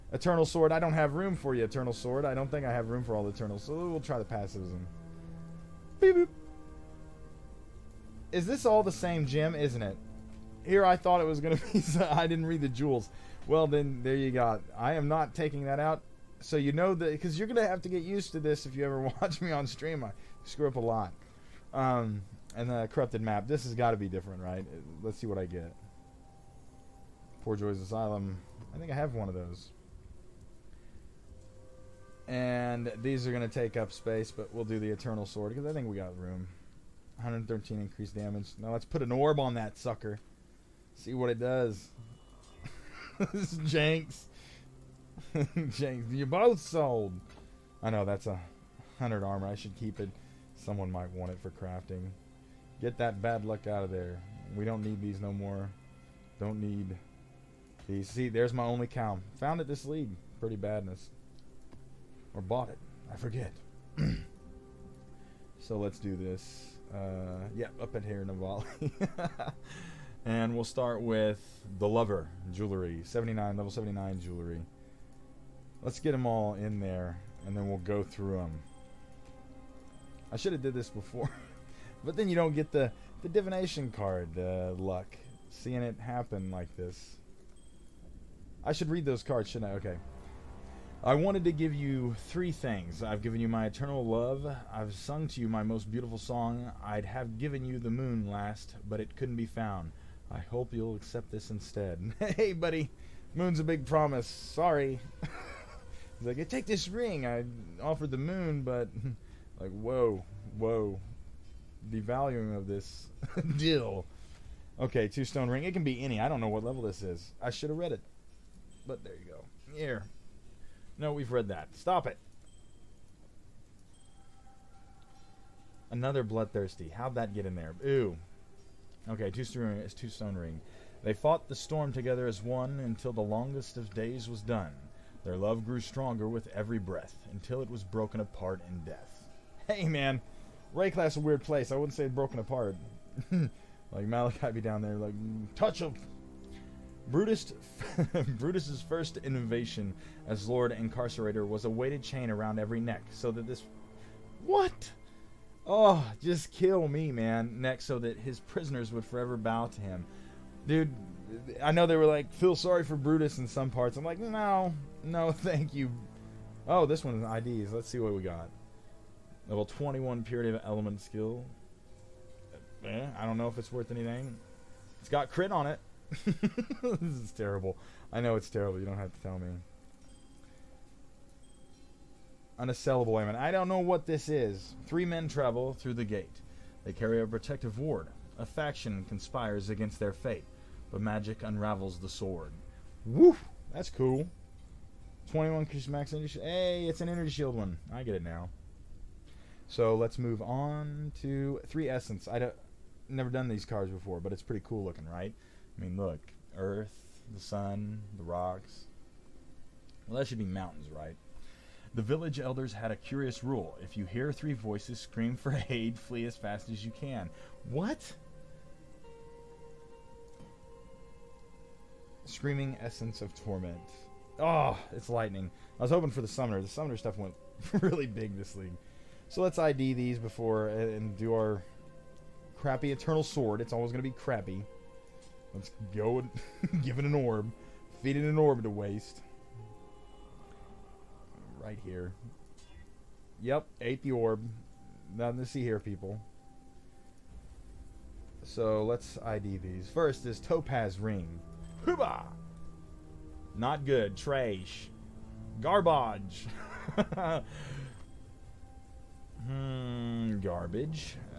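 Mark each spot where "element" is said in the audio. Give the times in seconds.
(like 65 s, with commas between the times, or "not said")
170 s, 183 s.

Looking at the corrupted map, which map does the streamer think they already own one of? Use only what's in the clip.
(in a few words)
Poorjoy's Asylum.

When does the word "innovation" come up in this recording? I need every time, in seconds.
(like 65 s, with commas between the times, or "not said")
149 s.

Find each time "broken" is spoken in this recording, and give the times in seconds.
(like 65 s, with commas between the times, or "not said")
137 s, 142 s.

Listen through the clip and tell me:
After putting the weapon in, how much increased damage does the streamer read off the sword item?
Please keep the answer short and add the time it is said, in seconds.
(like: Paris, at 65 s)
113, at 37 s.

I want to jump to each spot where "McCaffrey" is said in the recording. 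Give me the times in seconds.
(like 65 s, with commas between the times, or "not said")
not said.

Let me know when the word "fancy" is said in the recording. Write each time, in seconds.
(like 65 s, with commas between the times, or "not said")
not said.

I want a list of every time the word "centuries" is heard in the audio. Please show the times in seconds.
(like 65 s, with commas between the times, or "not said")
not said.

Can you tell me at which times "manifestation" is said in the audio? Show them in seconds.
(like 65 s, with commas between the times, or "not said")
not said.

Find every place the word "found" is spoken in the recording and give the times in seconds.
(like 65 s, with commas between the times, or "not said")
59 s, 99 s.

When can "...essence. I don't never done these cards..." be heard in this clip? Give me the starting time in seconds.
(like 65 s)
201 s.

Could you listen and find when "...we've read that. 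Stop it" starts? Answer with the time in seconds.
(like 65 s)
121 s.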